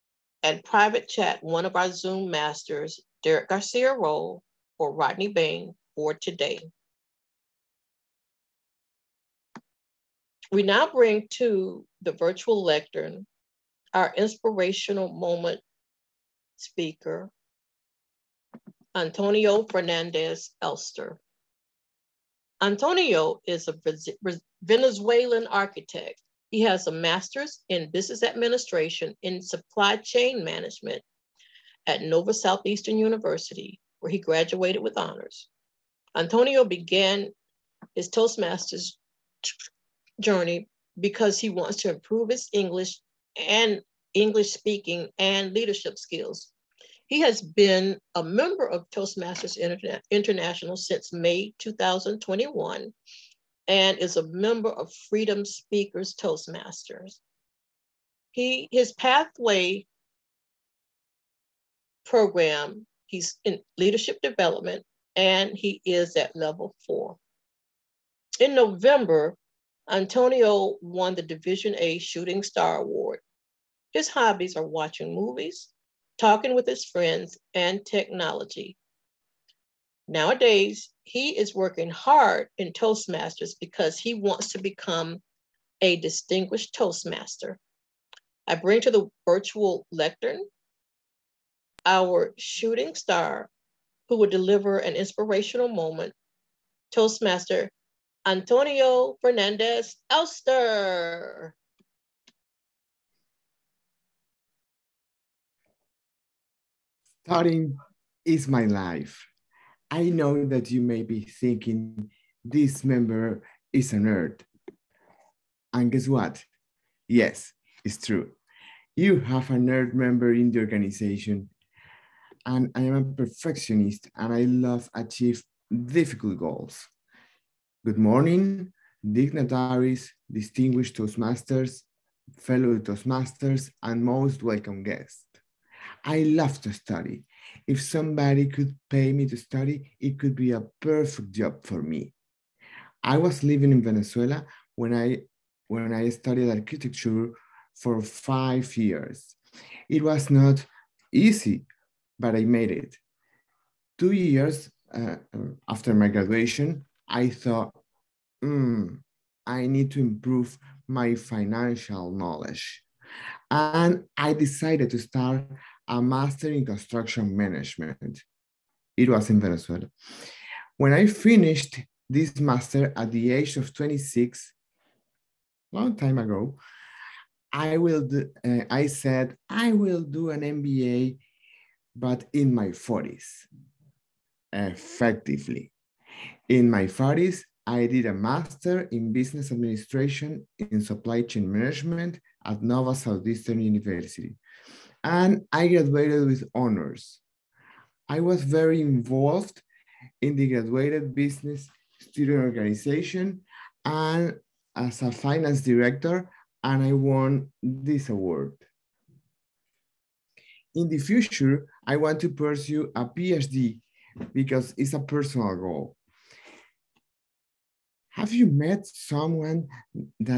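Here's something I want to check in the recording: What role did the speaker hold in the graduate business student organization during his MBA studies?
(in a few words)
finance director.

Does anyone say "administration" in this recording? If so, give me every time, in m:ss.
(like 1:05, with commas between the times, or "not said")
0:28, 3:09.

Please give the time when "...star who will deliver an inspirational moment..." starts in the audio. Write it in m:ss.
1:32.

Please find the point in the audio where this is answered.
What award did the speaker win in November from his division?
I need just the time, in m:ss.
1:11.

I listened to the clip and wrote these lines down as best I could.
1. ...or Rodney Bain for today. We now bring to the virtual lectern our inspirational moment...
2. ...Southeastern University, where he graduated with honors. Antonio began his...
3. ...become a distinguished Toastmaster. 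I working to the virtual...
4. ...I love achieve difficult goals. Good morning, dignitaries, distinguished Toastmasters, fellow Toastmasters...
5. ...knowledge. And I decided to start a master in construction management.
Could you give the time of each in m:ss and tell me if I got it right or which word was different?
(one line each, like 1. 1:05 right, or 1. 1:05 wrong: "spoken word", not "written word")
1. 0:04 right
2. 0:32 right
3. 1:24 wrong: "bring", not "working"
4. 2:04 right
5. 2:42 right.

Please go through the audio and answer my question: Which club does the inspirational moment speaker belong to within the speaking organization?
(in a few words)
Freedom Speakers Toastmasters.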